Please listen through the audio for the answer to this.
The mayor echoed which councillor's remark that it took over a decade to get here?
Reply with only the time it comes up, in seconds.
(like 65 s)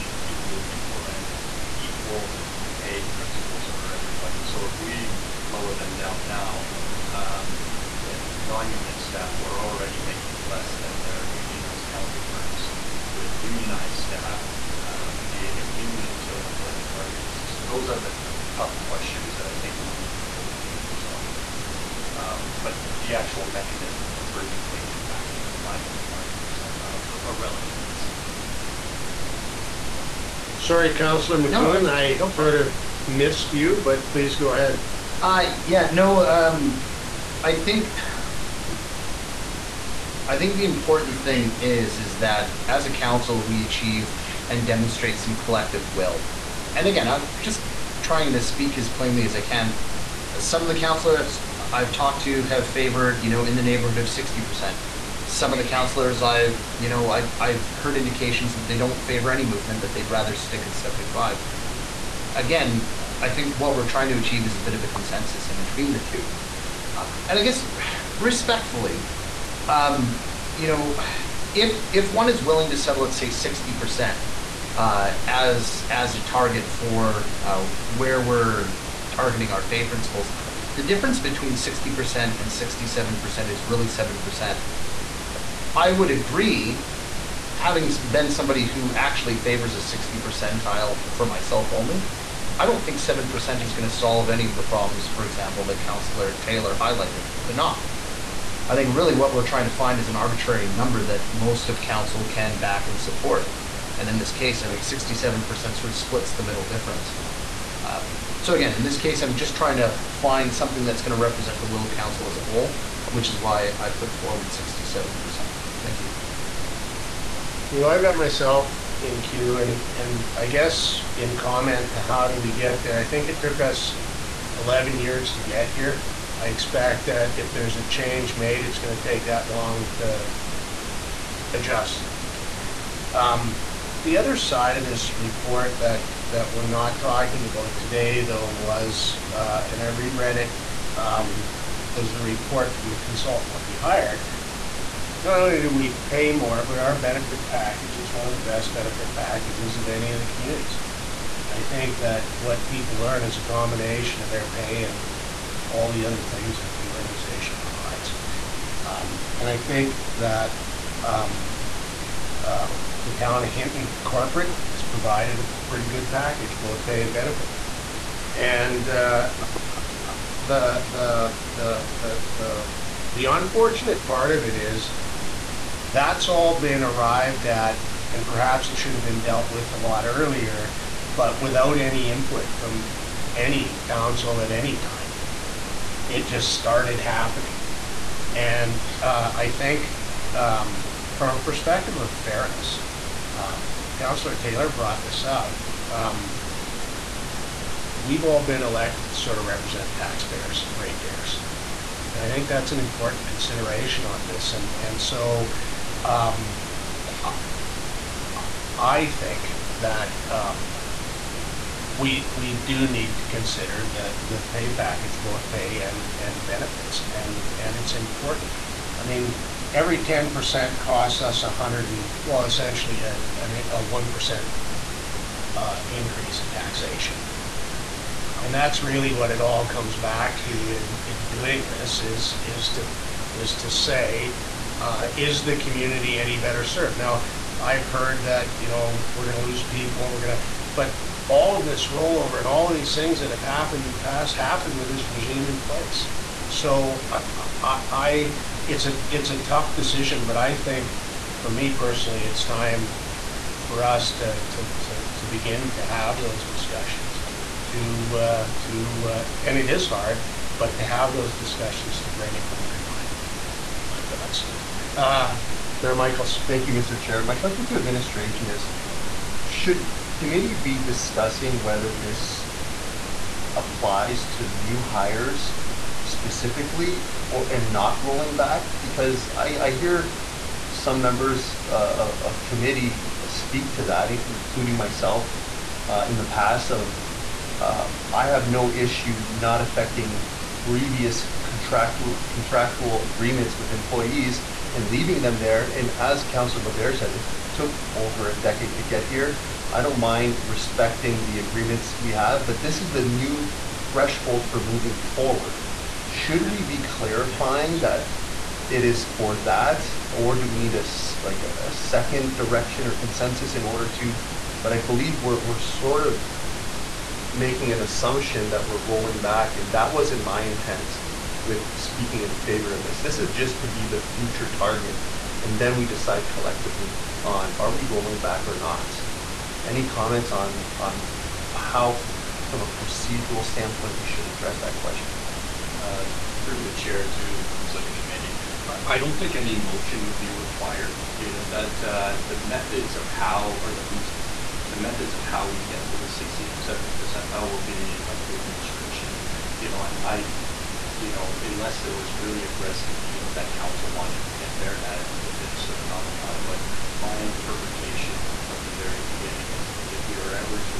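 296 s.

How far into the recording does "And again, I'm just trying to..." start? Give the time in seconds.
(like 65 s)
46 s.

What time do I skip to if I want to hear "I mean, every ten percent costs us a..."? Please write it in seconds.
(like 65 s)
218 s.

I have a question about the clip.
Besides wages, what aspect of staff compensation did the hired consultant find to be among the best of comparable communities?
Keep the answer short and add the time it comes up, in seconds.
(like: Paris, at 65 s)
benefit package, at 147 s.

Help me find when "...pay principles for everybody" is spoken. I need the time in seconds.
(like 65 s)
2 s.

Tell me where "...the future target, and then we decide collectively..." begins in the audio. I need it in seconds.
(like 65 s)
323 s.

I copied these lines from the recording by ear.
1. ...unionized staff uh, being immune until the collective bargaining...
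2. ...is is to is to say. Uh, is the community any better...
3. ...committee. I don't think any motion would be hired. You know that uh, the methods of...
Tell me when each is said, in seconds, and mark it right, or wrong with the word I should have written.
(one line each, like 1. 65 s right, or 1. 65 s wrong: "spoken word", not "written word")
1. 13 s right
2. 232 s right
3. 337 s wrong: "required", not "hired".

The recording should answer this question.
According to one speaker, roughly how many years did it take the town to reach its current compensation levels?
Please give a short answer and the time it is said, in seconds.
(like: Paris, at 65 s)
11 years, at 124 s.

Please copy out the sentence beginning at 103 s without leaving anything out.
And in this case, I think 67% sort of splits the middle difference.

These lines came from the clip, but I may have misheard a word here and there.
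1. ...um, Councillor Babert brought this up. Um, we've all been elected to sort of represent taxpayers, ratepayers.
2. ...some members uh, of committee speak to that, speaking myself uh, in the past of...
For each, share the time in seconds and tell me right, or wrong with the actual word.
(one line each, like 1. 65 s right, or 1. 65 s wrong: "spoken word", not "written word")
1. 193 s wrong: "Taylor", not "Babert"
2. 280 s wrong: "including", not "speaking".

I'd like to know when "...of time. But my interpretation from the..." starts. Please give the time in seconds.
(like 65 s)
356 s.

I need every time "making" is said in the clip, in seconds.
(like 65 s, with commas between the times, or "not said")
10 s, 317 s.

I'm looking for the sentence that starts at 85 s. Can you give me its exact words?
I would agree, having been somebody who actually favors a sixty percentile for myself only.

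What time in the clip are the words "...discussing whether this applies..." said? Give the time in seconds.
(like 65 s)
270 s.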